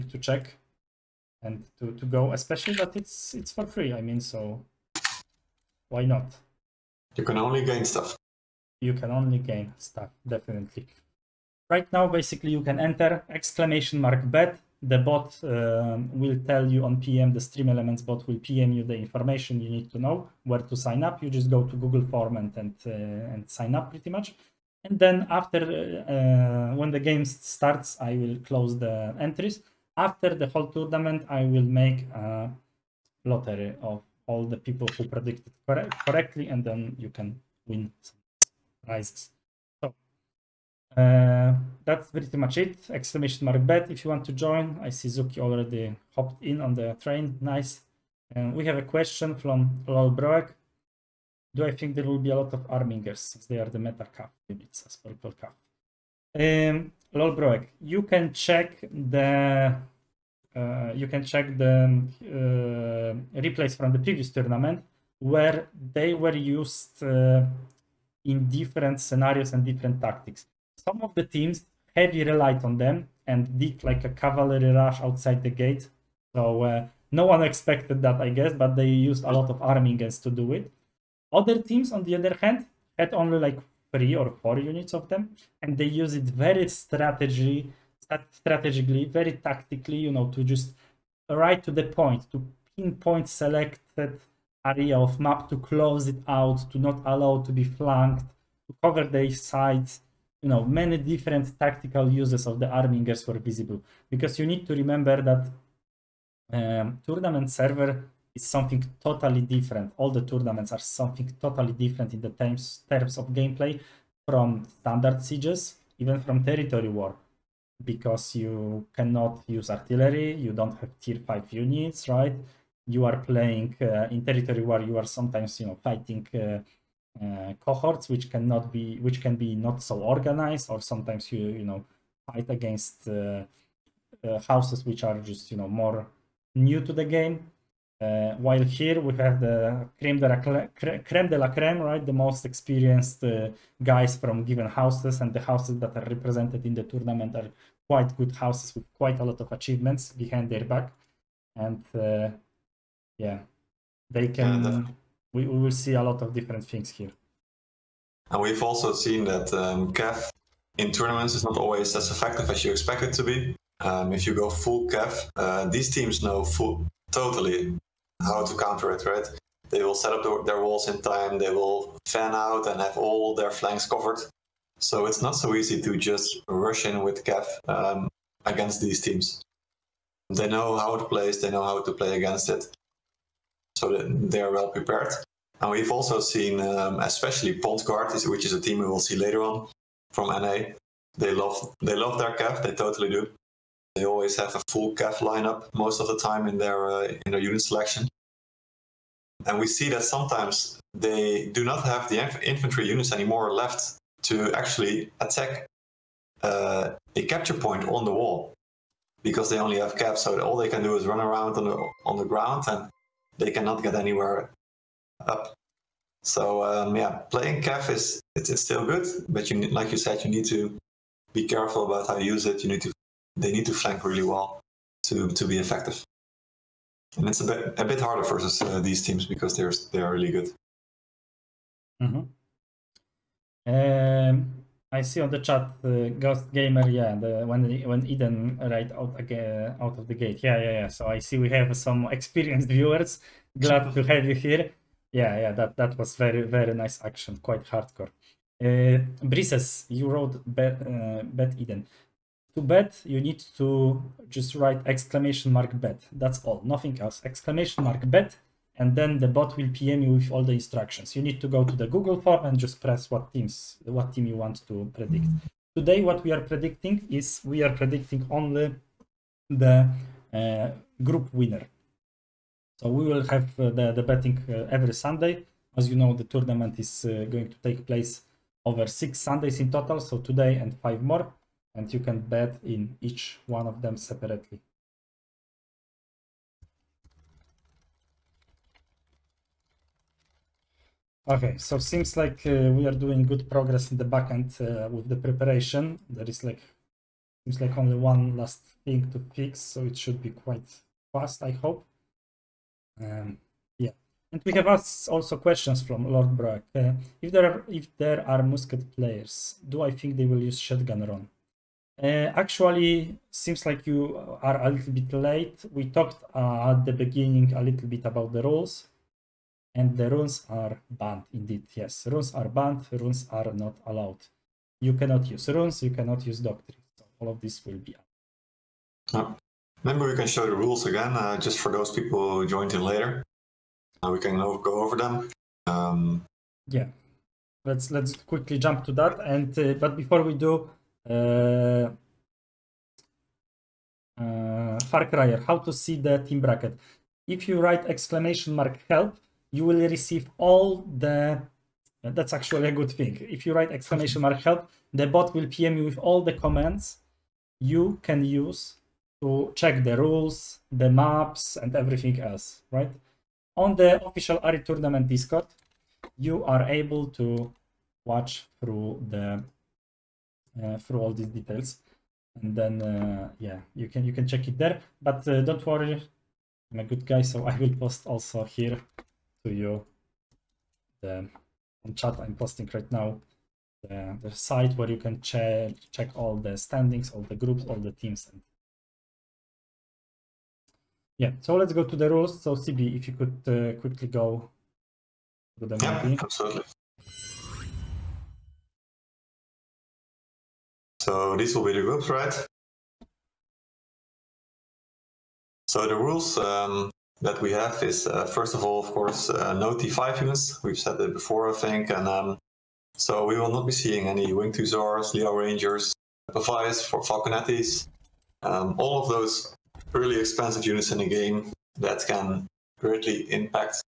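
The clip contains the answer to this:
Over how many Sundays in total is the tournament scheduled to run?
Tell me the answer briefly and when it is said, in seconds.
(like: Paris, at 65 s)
6, at 278 s.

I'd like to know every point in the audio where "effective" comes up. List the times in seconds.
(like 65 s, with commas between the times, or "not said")
162 s, 225 s.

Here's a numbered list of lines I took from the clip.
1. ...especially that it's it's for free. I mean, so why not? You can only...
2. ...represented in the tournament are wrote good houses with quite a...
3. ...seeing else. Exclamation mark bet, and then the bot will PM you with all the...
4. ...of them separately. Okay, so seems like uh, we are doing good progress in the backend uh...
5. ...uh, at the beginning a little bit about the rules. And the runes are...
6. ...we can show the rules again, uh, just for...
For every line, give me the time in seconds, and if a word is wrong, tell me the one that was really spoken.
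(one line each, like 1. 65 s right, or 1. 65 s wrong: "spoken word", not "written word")
1. 2 s right
2. 146 s wrong: "quite", not "wrote"
3. 256 s wrong: "nothing", not "seeing"
4. 283 s right
5. 316 s right
6. 329 s right.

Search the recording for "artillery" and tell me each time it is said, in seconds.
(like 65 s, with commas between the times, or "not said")
119 s.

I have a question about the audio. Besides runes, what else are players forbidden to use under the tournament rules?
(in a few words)
Doctrine.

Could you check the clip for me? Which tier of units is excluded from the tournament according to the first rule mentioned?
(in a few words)
Tier 5.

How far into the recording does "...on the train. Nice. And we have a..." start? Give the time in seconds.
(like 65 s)
46 s.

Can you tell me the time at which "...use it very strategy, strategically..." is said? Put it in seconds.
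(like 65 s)
85 s.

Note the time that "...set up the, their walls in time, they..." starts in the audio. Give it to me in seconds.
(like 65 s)
169 s.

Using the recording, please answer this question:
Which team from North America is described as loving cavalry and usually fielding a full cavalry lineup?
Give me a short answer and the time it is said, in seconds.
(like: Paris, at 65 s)
Pontguard, at 187 s.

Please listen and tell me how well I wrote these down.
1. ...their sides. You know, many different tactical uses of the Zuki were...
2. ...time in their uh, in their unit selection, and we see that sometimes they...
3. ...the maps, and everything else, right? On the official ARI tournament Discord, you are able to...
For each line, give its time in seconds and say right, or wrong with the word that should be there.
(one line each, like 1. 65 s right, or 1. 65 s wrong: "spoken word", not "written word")
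1. 99 s wrong: "Armingers", not "Zuki"
2. 196 s right
3. 360 s right.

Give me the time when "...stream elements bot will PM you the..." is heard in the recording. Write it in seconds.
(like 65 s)
17 s.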